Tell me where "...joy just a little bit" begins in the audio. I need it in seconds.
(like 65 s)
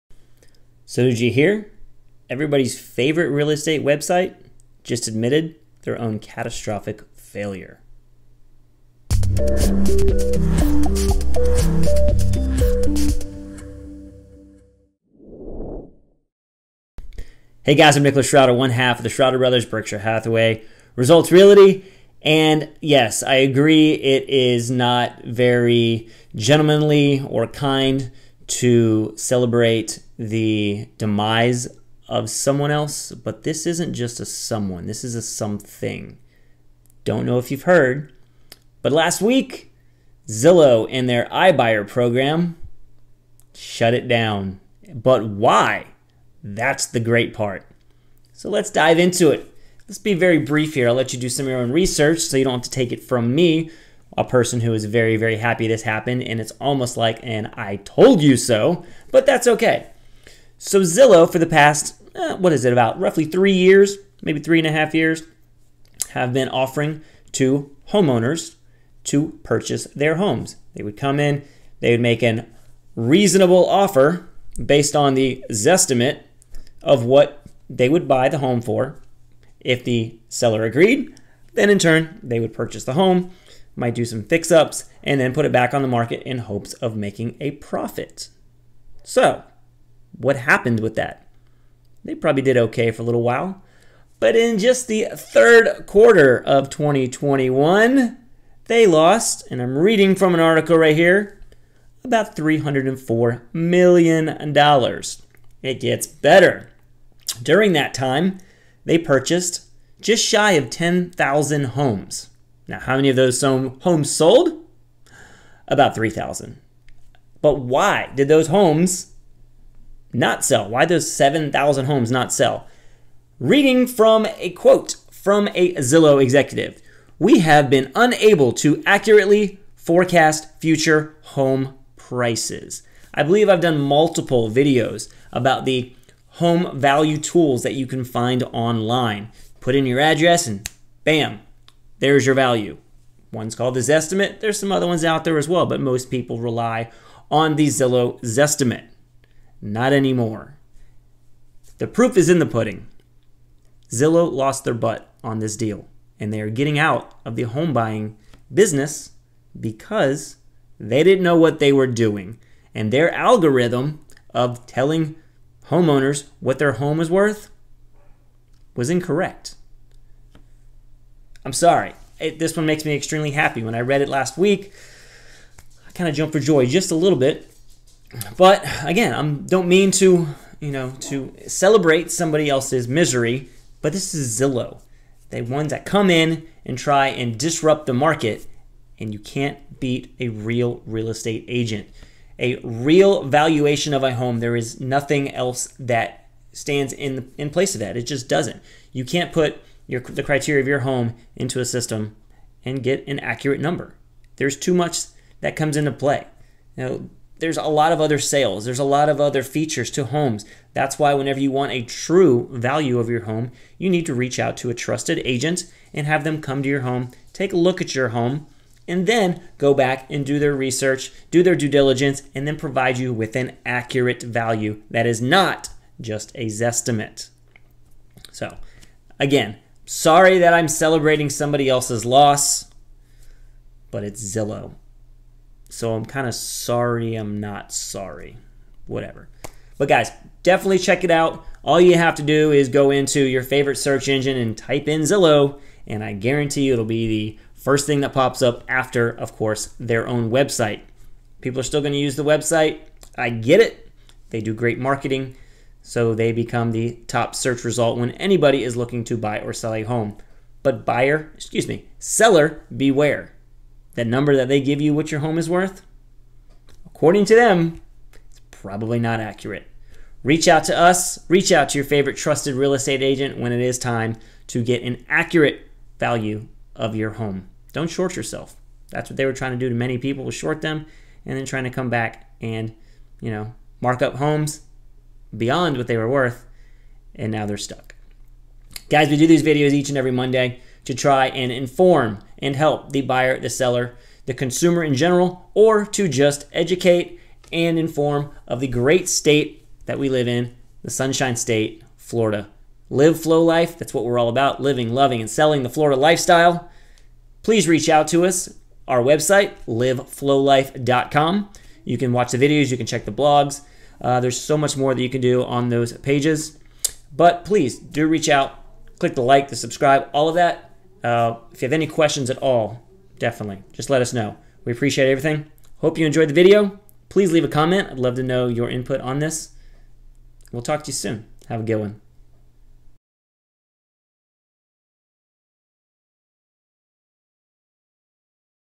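176 s.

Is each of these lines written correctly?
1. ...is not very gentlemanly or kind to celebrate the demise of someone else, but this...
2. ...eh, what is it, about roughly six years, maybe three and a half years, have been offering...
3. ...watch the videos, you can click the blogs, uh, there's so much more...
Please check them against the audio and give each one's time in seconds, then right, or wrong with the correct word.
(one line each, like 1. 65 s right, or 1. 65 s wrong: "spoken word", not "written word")
1. 24 s right
2. 62 s wrong: "three", not "six"
3. 312 s wrong: "check", not "click".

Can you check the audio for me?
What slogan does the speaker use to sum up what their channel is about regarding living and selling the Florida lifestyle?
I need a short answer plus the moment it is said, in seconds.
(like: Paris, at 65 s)
Live Flow Life, at 302 s.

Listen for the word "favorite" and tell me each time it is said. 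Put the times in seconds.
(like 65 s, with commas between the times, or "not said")
2 s, 243 s, 271 s.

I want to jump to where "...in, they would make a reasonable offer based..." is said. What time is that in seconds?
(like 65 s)
71 s.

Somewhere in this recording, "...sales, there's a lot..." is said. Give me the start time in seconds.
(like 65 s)
208 s.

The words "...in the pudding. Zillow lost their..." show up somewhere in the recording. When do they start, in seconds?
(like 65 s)
152 s.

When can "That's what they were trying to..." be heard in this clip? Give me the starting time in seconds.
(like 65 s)
278 s.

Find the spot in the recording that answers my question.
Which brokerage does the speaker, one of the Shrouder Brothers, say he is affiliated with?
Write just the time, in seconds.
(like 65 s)
19 s.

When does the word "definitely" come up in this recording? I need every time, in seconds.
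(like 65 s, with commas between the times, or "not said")
240 s, 323 s.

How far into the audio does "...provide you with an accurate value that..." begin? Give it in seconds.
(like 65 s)
222 s.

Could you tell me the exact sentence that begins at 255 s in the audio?
So they become the top search result when anybody is looking to buy or sell a home.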